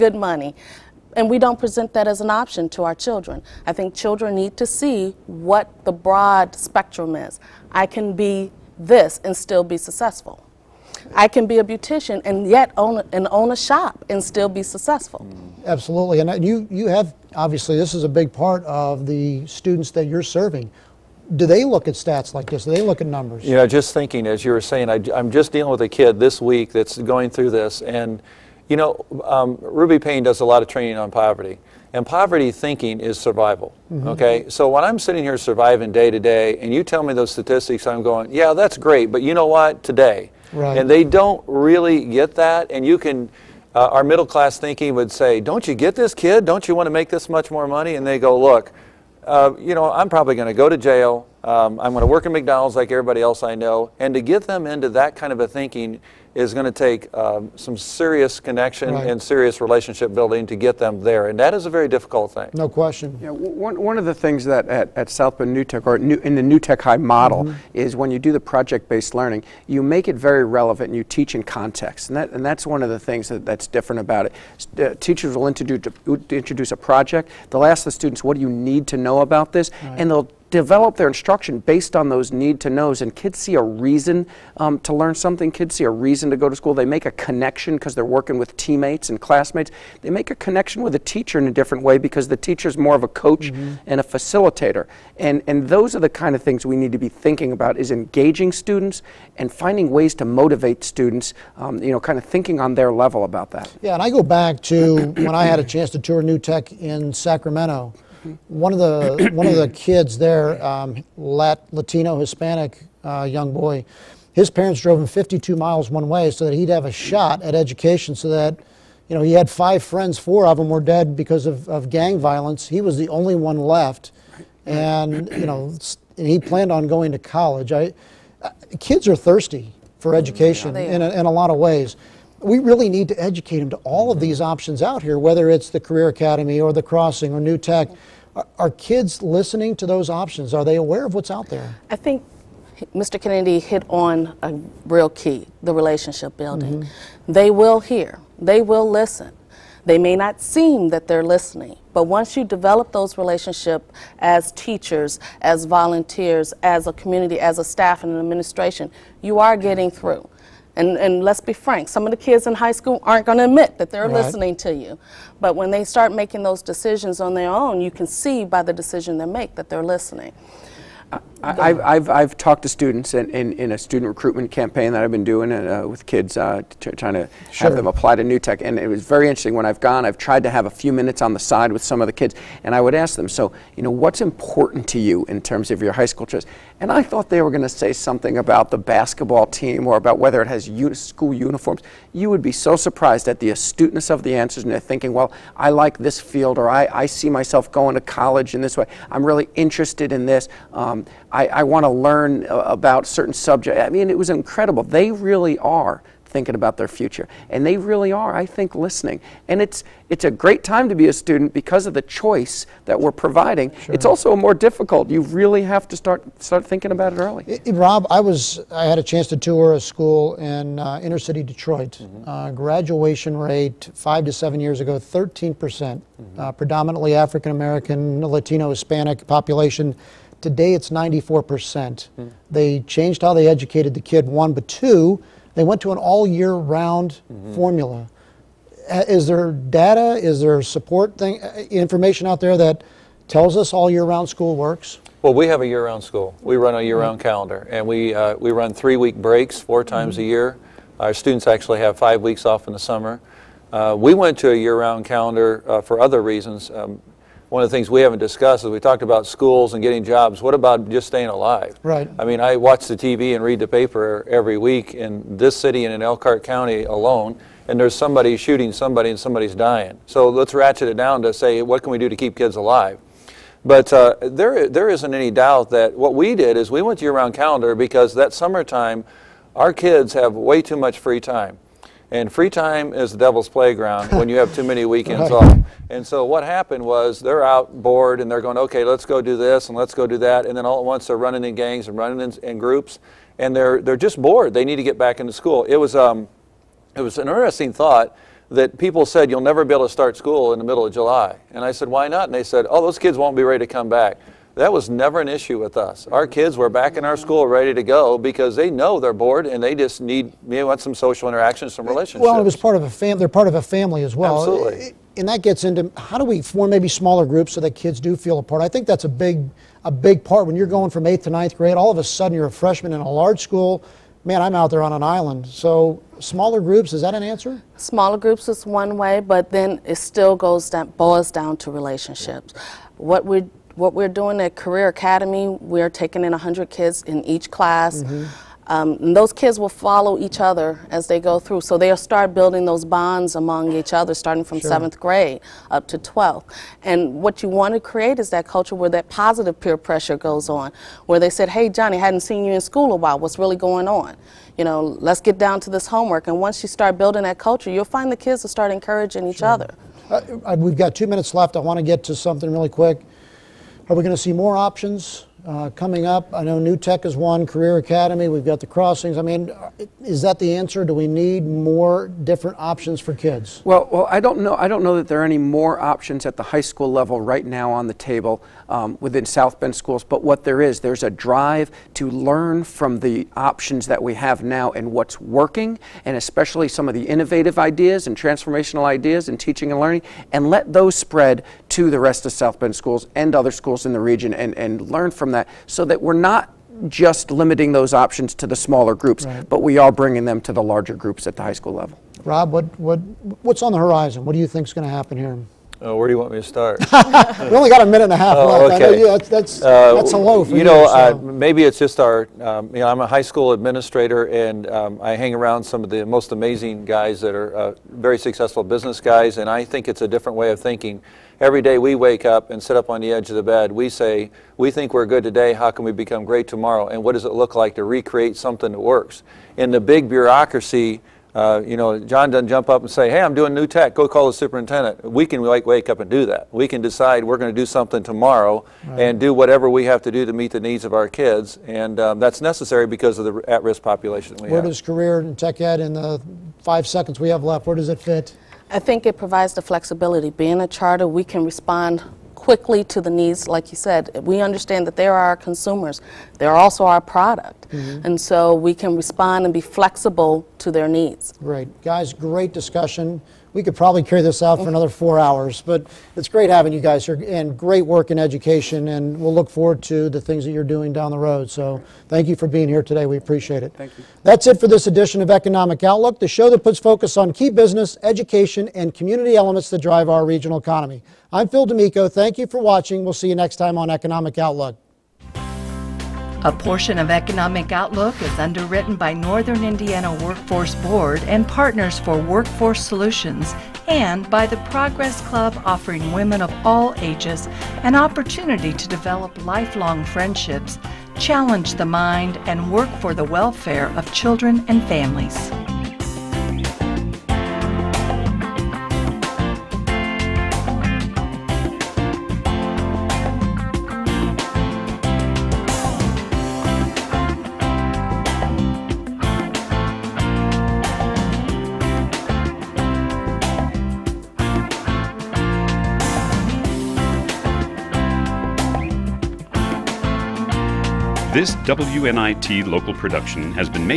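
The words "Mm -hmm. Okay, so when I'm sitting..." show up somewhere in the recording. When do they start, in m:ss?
0:33.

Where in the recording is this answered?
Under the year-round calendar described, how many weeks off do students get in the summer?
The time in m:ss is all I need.
4:11.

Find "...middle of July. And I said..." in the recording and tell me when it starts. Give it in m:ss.
5:00.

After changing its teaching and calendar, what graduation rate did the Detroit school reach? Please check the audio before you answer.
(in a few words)
94%.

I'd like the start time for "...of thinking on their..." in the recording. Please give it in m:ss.
1:42.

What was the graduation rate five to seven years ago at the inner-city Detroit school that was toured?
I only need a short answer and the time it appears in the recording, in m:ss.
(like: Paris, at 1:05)
13%, at 3:44.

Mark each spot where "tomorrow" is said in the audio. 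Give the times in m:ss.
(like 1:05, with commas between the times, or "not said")
7:06, 7:18.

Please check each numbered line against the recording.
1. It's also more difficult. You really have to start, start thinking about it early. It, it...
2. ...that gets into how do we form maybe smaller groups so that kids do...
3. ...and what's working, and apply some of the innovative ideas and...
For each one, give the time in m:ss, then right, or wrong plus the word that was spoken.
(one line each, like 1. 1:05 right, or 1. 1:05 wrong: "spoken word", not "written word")
1. 3:33 right
2. 5:15 right
3. 6:24 wrong: "especially", not "apply".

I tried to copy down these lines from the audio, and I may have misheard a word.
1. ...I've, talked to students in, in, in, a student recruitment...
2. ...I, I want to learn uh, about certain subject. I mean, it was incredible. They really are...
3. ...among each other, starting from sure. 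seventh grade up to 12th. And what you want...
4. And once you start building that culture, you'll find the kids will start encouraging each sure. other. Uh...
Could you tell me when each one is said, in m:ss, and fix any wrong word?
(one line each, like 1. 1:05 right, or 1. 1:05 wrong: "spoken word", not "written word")
1. 2:52 right
2. 3:21 right
3. 5:43 right
4. 5:56 right.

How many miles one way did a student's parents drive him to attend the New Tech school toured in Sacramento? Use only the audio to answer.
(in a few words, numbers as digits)
52.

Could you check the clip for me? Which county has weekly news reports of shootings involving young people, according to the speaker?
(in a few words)
Elkhart County.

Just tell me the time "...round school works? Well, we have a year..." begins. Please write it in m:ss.
4:04.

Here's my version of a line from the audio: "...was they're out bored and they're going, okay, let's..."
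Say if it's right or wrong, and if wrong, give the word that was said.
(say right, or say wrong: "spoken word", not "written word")
right.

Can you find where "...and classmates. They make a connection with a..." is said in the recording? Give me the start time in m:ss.
1:29.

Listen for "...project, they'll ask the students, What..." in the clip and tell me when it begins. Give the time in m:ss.
1:16.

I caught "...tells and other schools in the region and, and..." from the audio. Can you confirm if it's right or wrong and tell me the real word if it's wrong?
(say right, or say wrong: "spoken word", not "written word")
wrong: "schools", not "tells".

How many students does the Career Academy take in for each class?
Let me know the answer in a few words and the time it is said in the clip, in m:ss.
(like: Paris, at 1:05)
100, at 5:36.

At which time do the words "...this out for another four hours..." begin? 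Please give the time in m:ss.
7:44.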